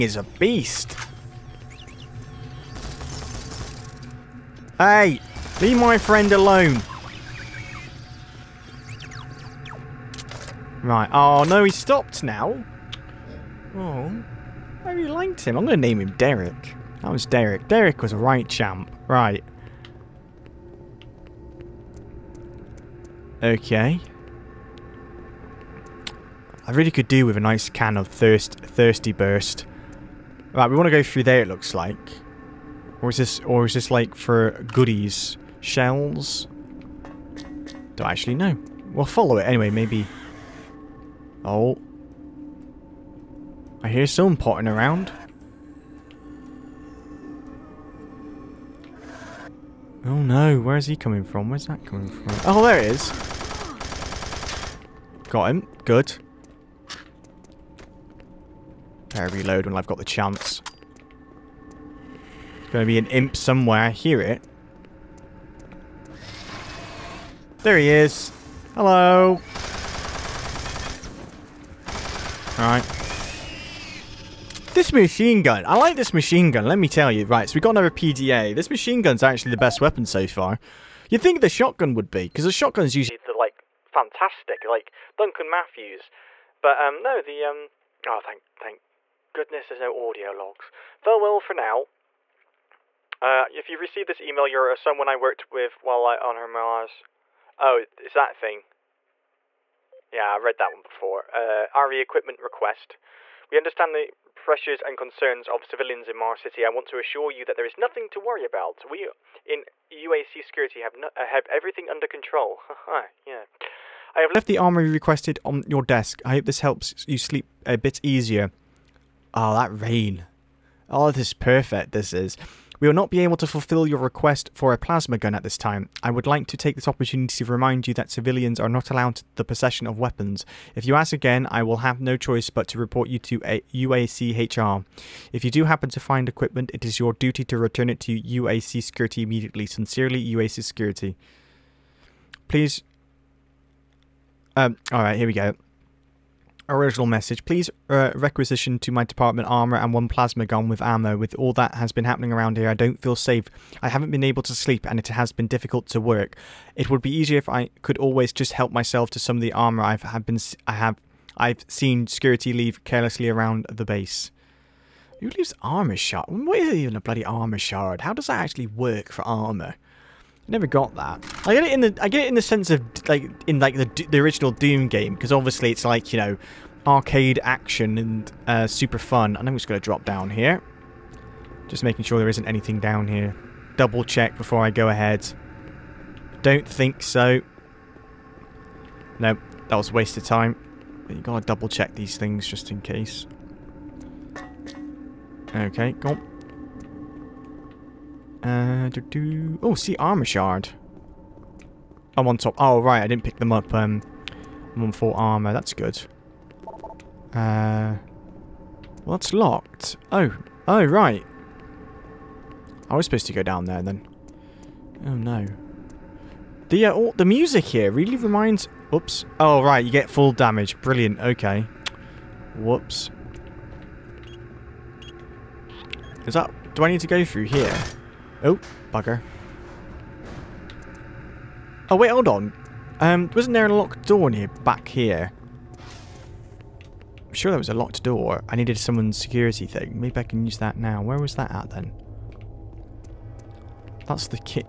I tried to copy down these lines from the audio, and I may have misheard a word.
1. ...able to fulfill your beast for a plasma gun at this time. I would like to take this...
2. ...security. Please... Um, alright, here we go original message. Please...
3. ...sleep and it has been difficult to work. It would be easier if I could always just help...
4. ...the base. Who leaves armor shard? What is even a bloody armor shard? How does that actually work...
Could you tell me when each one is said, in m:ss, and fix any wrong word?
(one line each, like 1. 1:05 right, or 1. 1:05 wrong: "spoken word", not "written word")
1. 2:03 wrong: "request", not "beast"
2. 2:20 right
3. 2:34 right
4. 2:43 right.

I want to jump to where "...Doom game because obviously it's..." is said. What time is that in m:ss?
2:54.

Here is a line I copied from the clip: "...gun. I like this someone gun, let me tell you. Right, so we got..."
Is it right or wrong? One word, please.
wrong.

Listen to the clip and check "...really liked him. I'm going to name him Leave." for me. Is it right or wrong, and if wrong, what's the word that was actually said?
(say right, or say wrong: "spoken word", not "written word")
wrong: "Derek", not "Leave".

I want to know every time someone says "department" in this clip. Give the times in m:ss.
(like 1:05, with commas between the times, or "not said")
2:29.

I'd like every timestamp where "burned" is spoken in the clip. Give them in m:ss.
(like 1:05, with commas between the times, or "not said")
not said.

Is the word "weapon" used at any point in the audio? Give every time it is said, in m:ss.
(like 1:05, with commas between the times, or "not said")
1:19, 2:09.